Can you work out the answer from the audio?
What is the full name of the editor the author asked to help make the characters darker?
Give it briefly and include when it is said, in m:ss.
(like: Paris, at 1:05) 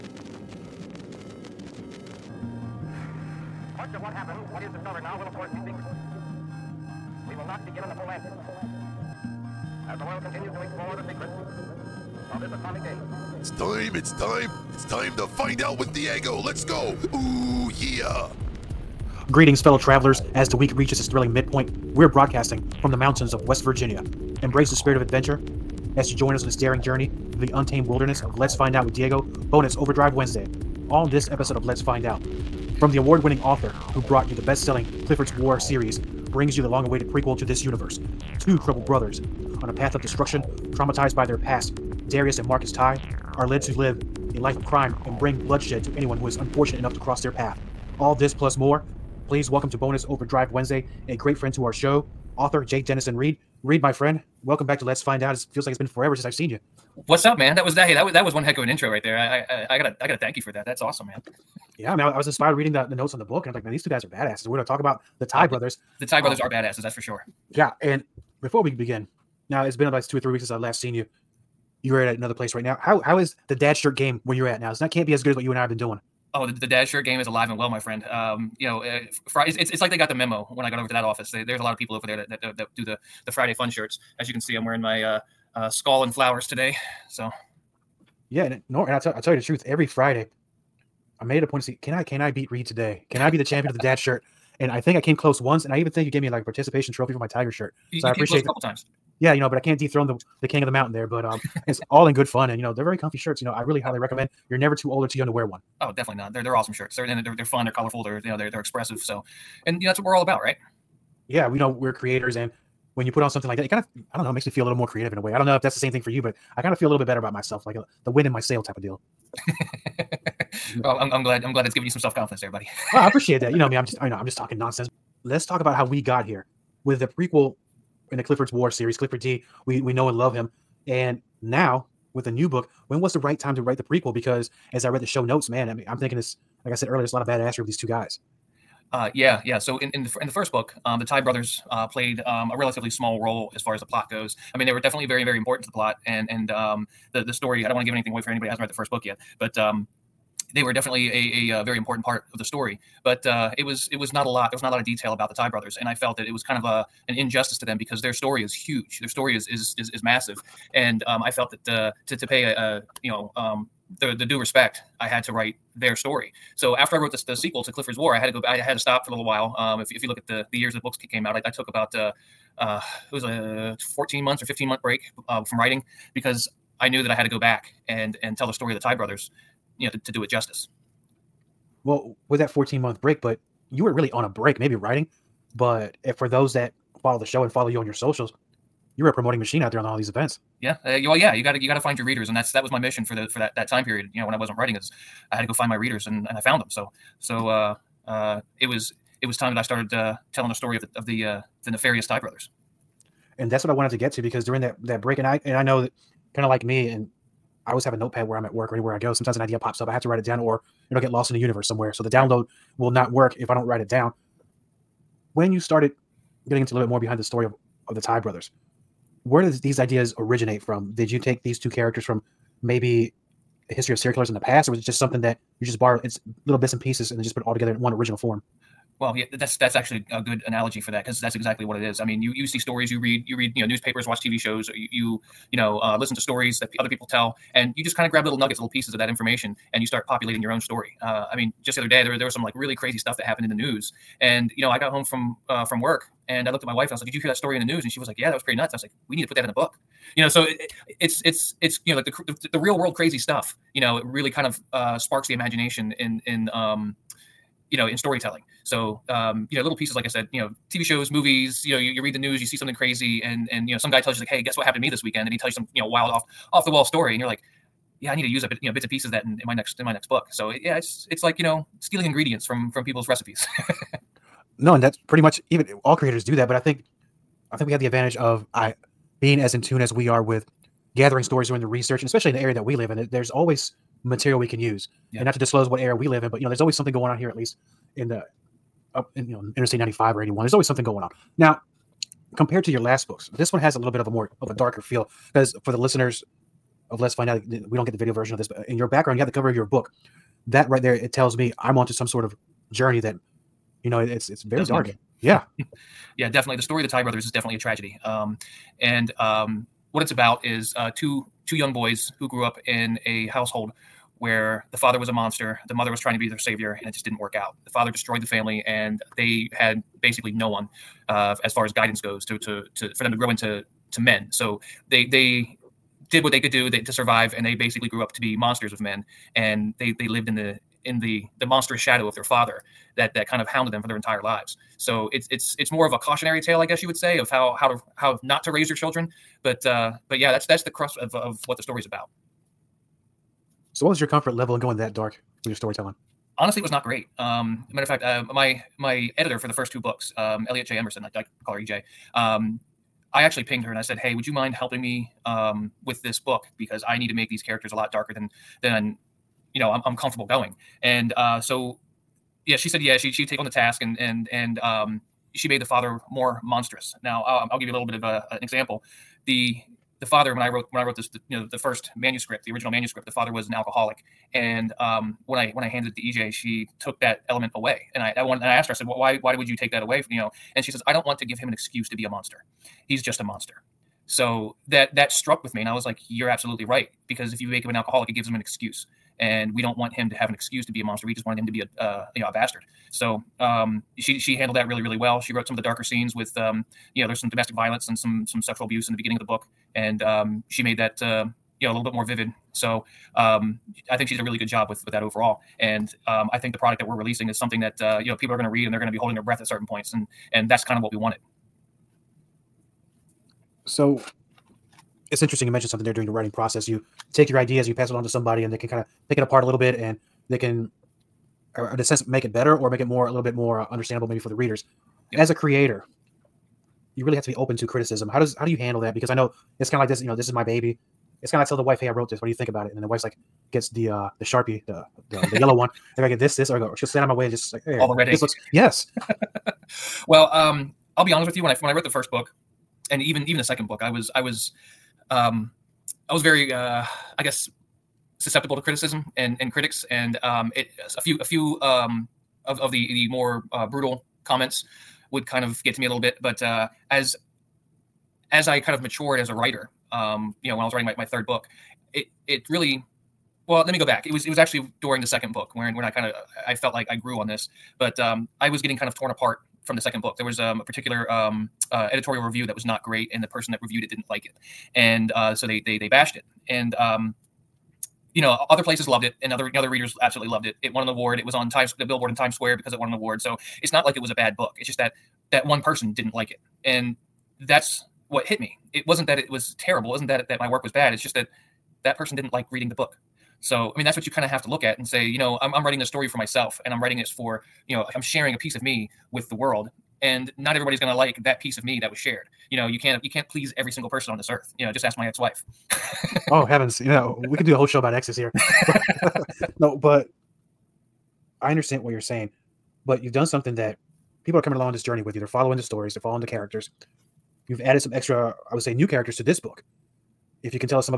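Elliot J. Emerson, at 5:50.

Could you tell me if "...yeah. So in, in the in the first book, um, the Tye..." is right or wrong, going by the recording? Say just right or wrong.
right.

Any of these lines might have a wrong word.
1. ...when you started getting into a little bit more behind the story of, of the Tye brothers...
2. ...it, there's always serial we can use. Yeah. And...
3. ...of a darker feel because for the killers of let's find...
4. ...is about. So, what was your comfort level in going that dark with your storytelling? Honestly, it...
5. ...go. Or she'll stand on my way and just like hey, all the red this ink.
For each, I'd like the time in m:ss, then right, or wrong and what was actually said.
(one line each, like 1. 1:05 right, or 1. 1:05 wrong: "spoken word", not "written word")
1. 3:35 right
2. 4:42 wrong: "material", not "serial"
3. 4:54 wrong: "listeners", not "killers"
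4. 5:41 right
5. 7:16 right.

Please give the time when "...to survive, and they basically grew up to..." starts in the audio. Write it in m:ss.
5:26.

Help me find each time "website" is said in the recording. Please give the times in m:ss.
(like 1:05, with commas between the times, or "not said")
not said.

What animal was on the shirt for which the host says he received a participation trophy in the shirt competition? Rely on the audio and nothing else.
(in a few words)
tiger.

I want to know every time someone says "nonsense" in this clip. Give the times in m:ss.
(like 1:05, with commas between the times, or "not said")
2:04.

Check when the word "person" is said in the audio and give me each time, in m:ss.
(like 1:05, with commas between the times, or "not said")
7:53, 8:05, 8:11, 8:23.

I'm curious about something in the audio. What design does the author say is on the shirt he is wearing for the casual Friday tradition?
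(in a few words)
skull and flowers.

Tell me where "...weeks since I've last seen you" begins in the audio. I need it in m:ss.
1:10.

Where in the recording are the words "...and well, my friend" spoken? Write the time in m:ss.
1:17.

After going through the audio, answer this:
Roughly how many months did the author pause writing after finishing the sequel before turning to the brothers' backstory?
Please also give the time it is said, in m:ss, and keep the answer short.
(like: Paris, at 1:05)
15 months, at 2:54.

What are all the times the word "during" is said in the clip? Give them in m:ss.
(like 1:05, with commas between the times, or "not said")
3:24, 6:55, 7:44.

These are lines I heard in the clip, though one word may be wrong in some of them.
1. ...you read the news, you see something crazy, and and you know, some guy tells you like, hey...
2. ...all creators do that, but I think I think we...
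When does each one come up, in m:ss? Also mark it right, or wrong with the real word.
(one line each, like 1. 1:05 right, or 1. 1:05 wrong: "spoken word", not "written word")
1. 4:21 right
2. 4:35 right.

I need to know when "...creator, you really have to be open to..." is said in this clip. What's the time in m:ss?
7:05.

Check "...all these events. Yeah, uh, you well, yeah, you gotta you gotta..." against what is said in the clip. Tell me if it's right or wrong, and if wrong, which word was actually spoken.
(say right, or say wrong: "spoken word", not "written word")
right.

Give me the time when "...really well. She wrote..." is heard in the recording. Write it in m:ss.
6:34.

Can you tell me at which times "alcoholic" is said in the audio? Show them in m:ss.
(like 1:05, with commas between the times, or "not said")
6:13, 6:27.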